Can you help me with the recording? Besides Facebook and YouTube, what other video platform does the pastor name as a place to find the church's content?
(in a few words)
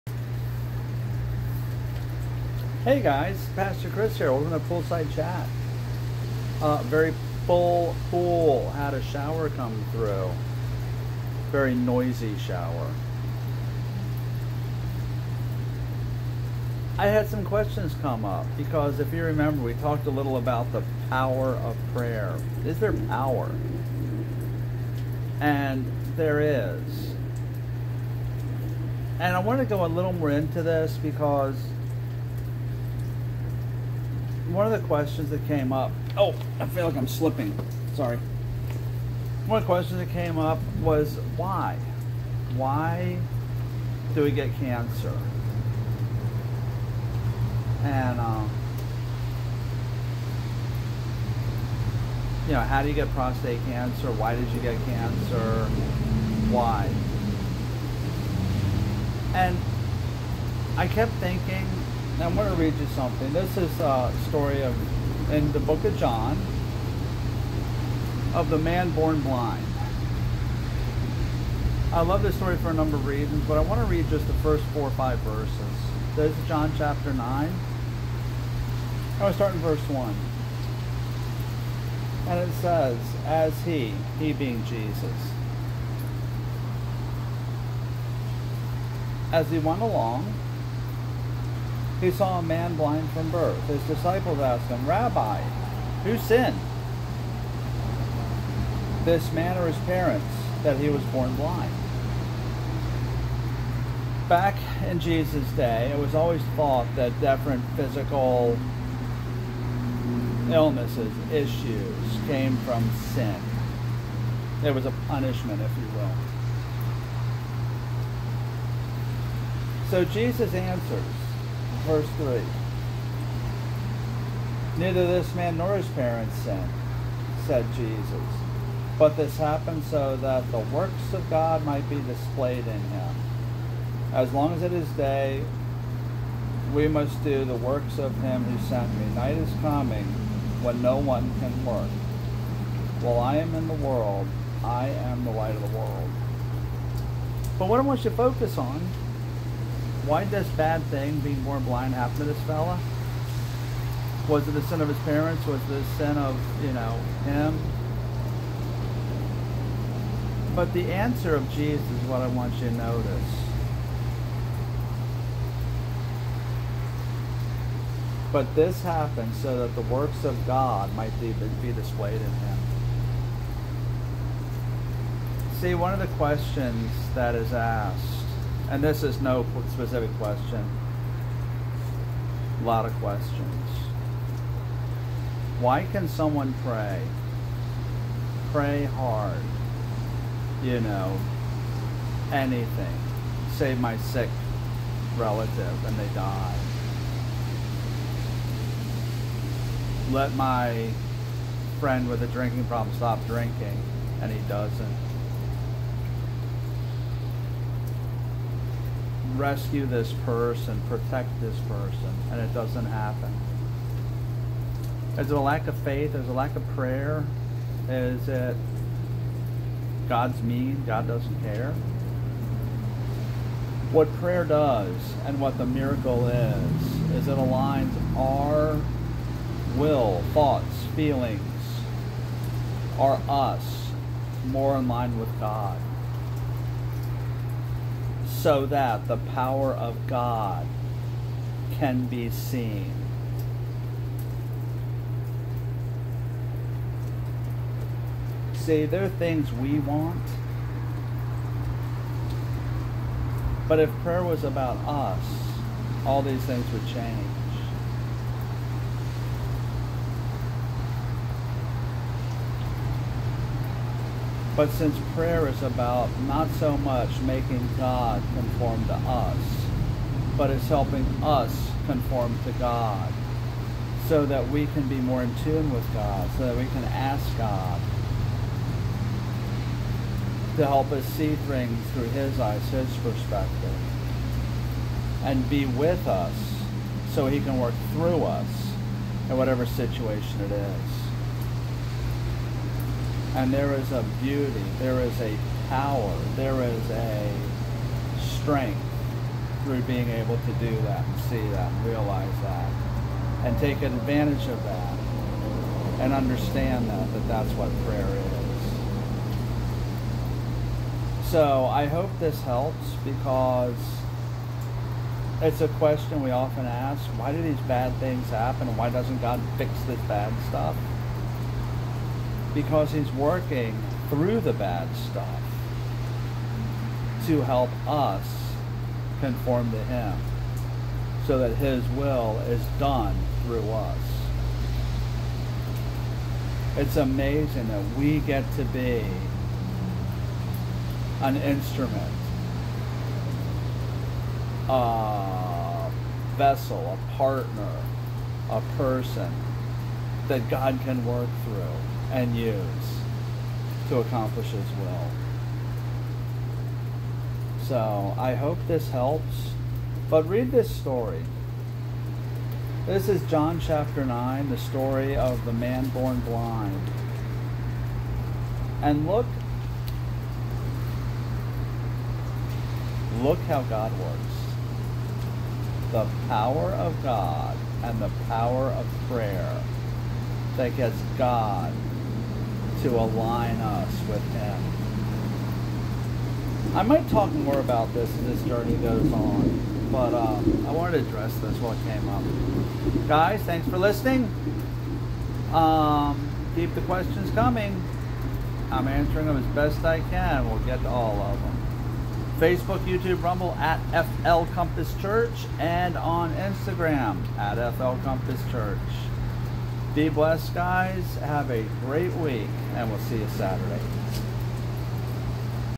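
Rumble.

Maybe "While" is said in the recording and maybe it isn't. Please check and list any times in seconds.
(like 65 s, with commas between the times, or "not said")
143 s.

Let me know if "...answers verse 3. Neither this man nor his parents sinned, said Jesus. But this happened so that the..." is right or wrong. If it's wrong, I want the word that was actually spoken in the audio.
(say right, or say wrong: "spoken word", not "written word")
right.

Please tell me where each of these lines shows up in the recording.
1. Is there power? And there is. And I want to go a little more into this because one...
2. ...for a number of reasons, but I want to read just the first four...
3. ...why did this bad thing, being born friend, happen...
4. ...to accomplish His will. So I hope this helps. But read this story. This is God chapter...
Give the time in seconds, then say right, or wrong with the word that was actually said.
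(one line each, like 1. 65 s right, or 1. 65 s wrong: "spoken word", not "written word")
1. 22 s right
2. 72 s right
3. 150 s wrong: "blind", not "friend"
4. 353 s wrong: "John", not "God".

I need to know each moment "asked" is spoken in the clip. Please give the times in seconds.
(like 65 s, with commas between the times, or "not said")
94 s, 177 s.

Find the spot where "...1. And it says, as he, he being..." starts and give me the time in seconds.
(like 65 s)
79 s.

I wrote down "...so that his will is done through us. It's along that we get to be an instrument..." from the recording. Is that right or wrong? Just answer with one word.
wrong.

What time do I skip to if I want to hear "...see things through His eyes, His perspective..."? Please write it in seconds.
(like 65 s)
281 s.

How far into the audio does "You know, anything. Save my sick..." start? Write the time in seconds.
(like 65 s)
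190 s.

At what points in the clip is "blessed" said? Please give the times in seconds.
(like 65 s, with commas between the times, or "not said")
410 s.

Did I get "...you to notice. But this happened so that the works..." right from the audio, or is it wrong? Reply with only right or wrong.
right.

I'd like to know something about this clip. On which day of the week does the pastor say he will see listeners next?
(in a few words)
Saturday.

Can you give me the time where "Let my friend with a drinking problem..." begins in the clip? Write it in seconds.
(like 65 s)
200 s.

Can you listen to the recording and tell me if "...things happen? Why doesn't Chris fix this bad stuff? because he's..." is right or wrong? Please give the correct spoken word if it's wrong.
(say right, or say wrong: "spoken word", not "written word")
wrong: "God", not "Chris".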